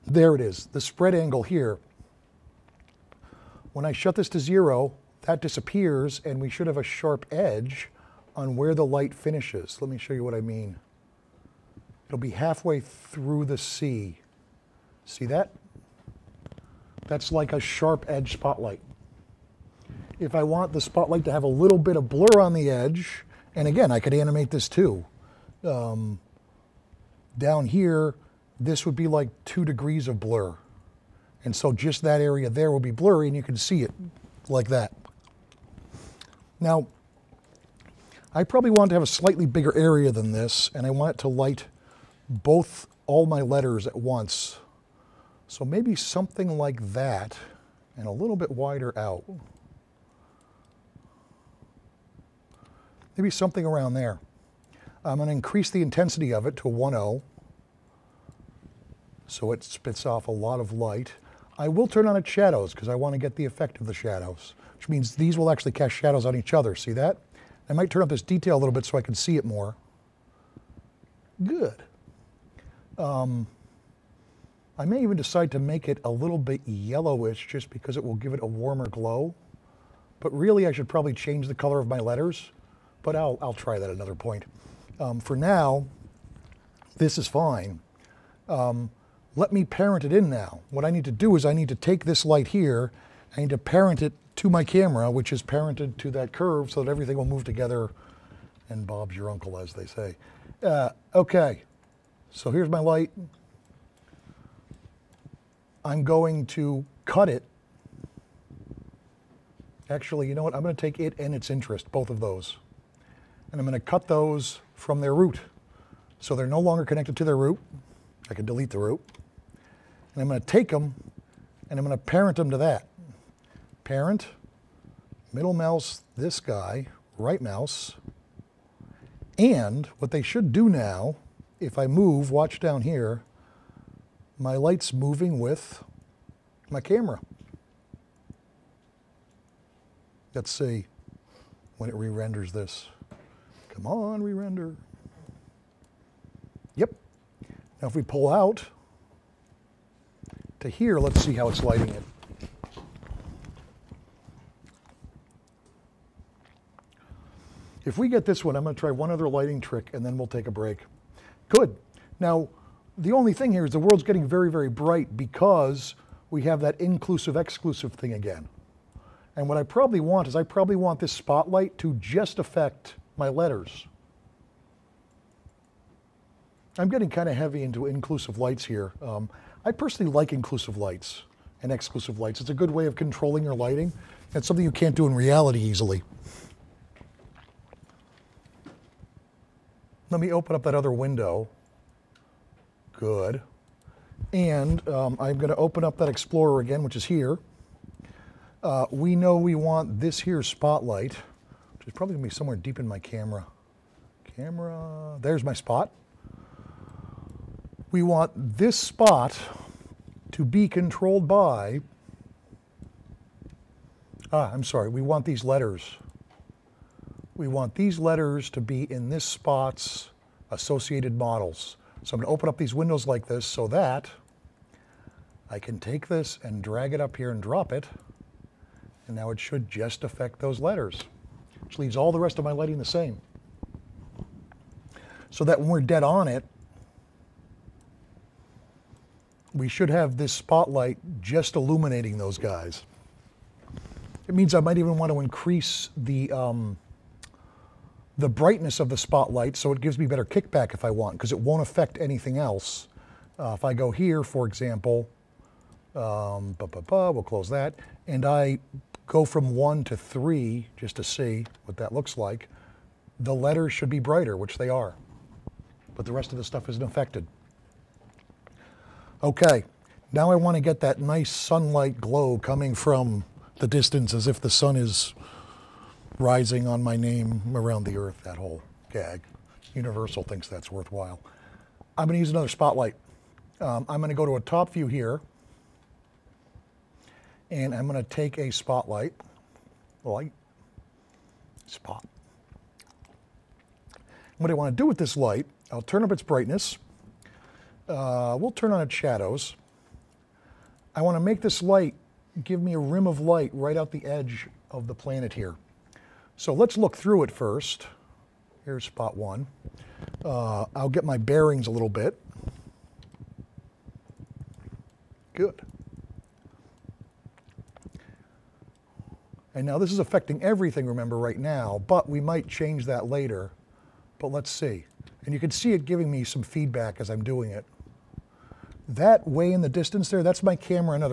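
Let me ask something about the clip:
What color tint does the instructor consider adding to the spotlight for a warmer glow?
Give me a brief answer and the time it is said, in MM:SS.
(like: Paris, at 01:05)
yellowish, at 01:16.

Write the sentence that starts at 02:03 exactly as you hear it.
Parent, middle mouse, this guy, right mouse.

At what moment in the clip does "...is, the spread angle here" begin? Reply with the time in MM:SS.
00:00.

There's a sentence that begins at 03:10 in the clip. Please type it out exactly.
Let me open up that other window.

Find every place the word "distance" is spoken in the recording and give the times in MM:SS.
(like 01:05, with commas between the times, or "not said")
04:33, 05:29.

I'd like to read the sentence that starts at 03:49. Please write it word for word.
And now it should just affect those letters which leaves all the rest of my lighting the same.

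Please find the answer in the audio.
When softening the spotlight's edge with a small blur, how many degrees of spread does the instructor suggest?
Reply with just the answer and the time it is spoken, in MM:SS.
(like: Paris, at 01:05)
2 degrees, at 00:29.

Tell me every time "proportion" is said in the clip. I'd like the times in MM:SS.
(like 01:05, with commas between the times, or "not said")
not said.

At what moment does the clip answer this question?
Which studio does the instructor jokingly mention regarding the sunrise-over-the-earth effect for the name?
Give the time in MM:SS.
04:39.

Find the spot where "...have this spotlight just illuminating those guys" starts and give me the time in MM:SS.
03:59.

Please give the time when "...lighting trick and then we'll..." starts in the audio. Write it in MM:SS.
02:39.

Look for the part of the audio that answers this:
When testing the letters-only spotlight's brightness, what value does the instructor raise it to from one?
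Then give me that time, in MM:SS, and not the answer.
04:19.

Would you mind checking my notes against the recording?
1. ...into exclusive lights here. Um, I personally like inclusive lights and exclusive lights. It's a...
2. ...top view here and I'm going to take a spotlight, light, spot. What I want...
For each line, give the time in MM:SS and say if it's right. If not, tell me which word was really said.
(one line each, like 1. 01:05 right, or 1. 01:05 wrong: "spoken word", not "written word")
1. 02:57 wrong: "inclusive", not "exclusive"
2. 04:44 right.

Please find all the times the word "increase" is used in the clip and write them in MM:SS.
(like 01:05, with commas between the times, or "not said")
00:55, 04:05.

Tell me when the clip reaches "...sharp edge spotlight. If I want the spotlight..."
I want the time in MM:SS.
00:17.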